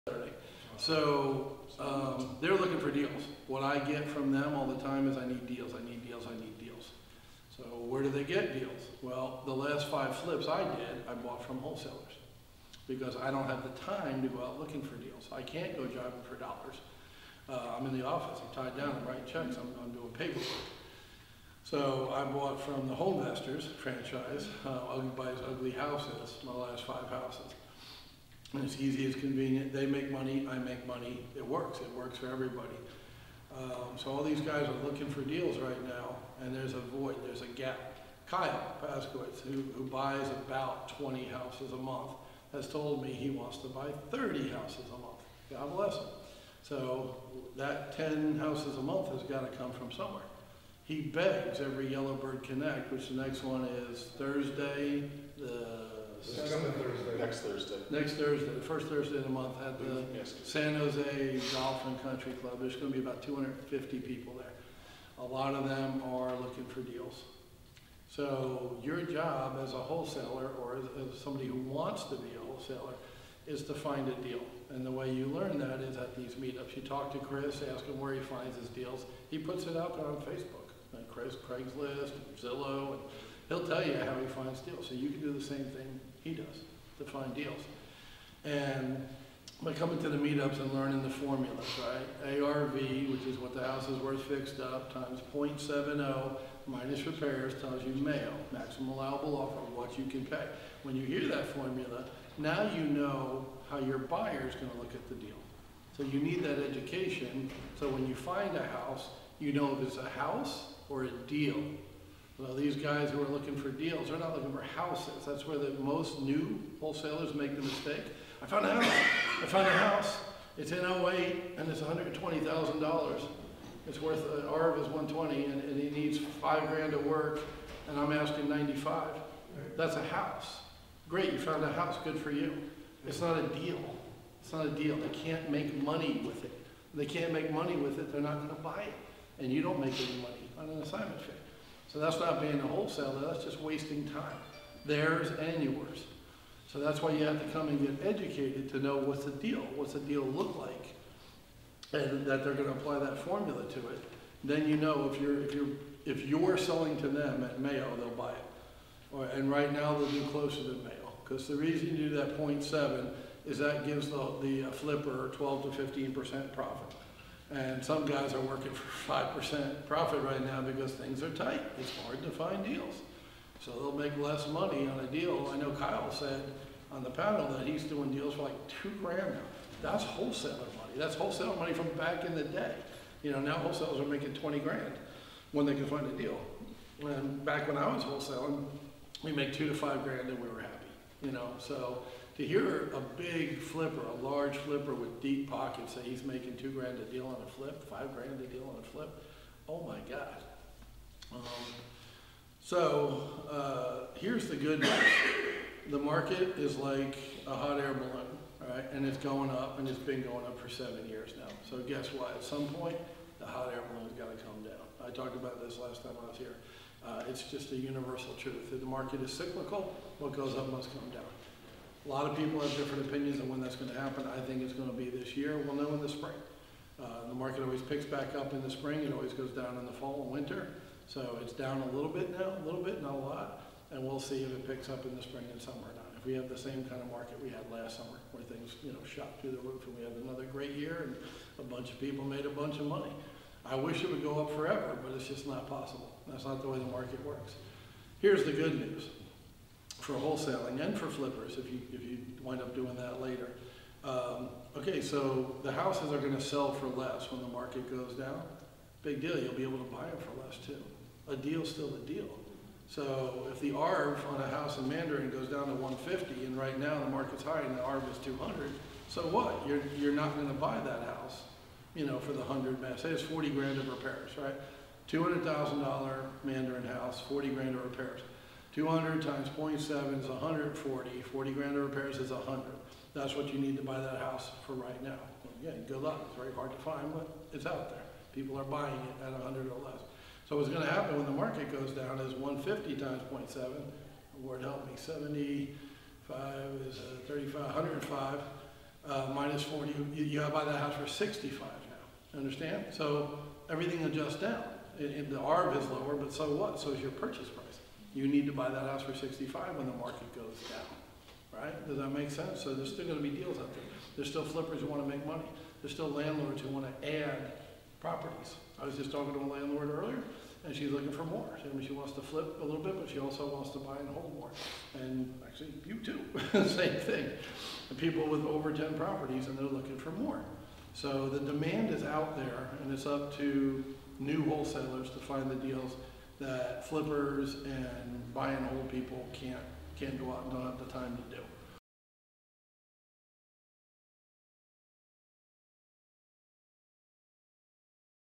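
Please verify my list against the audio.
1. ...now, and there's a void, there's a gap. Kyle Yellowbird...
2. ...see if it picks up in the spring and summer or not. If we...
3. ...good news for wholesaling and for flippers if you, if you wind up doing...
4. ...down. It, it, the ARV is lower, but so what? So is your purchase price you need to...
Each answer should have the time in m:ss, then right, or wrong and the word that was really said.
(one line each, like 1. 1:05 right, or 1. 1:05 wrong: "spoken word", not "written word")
1. 0:35 wrong: "Paskowitz", not "Yellowbird"
2. 3:54 right
3. 4:08 right
4. 5:04 right.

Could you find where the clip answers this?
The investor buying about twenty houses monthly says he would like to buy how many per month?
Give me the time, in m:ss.
0:44.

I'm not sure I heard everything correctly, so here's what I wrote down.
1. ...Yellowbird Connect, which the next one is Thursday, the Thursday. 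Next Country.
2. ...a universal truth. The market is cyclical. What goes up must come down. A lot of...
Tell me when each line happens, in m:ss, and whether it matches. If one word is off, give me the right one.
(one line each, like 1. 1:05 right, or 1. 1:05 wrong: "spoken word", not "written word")
1. 0:51 wrong: "Thursday", not "Country"
2. 3:37 right.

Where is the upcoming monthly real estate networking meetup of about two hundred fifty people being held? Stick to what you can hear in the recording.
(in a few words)
San Jose Golf and Country Club.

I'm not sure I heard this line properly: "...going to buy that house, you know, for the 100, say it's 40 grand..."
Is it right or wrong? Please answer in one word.
right.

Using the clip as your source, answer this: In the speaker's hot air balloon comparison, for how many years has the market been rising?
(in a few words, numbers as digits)
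7 years.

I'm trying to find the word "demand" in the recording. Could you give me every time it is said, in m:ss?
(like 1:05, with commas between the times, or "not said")
5:31.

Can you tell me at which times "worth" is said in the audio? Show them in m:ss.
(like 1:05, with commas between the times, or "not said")
1:34, 2:04.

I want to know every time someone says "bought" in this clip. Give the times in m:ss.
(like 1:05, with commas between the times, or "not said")
0:11, 0:22.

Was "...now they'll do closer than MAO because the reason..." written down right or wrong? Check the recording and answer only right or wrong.
right.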